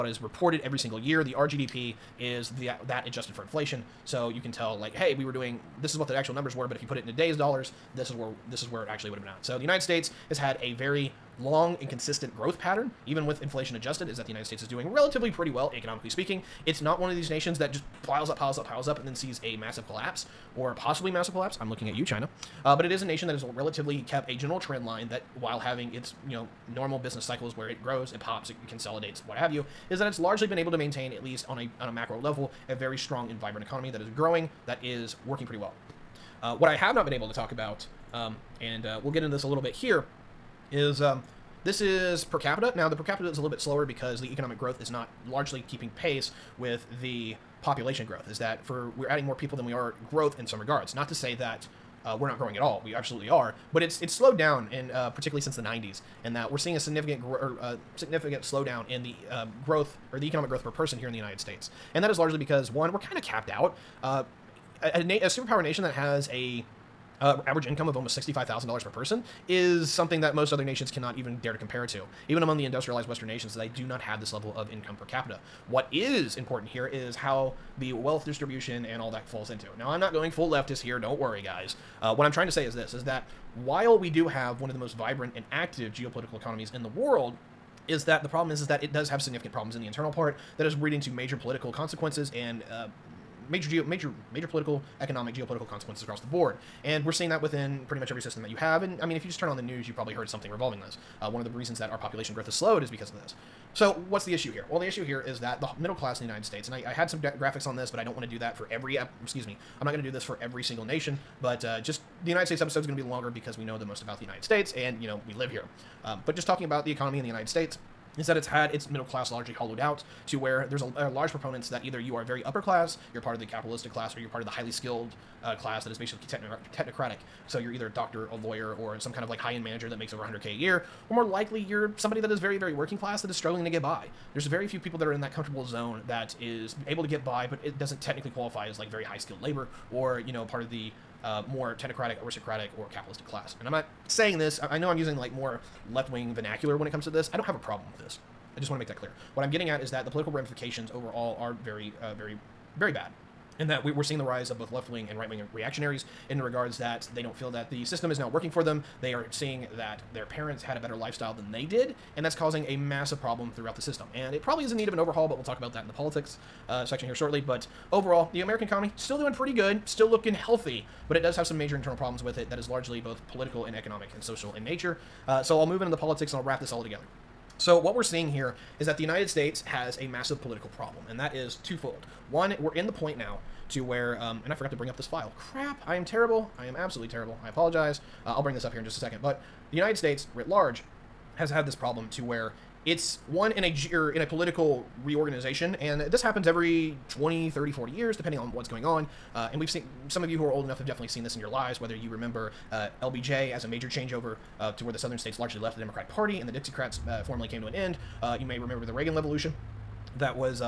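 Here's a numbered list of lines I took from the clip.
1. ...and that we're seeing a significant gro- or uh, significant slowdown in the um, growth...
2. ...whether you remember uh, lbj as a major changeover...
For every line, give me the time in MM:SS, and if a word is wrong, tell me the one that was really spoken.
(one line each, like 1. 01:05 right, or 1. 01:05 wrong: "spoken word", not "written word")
1. 00:56 right
2. 03:21 right.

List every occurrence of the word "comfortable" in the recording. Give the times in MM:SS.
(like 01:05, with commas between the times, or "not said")
02:15.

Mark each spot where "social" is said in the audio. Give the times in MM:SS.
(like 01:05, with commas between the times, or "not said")
02:54.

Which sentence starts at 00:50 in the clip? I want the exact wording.
Not to say that uh, we're not growing at all.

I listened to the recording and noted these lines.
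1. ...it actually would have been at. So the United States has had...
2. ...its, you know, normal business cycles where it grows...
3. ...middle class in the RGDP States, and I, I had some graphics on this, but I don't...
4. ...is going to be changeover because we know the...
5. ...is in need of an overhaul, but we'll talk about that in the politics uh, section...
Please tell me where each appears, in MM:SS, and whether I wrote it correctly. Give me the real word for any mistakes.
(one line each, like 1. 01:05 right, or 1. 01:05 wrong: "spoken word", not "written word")
1. 00:08 right
2. 00:25 right
3. 01:45 wrong: "United", not "RGDP"
4. 01:52 wrong: "longer", not "changeover"
5. 02:44 right.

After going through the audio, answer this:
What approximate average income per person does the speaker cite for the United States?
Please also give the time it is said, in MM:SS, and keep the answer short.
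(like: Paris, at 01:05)
$65,000, at 01:08.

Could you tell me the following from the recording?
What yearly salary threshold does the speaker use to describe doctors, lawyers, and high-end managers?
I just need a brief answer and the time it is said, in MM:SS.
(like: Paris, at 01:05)
100k, at 02:10.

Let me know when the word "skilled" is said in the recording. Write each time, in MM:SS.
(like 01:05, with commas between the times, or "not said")
02:04, 02:19.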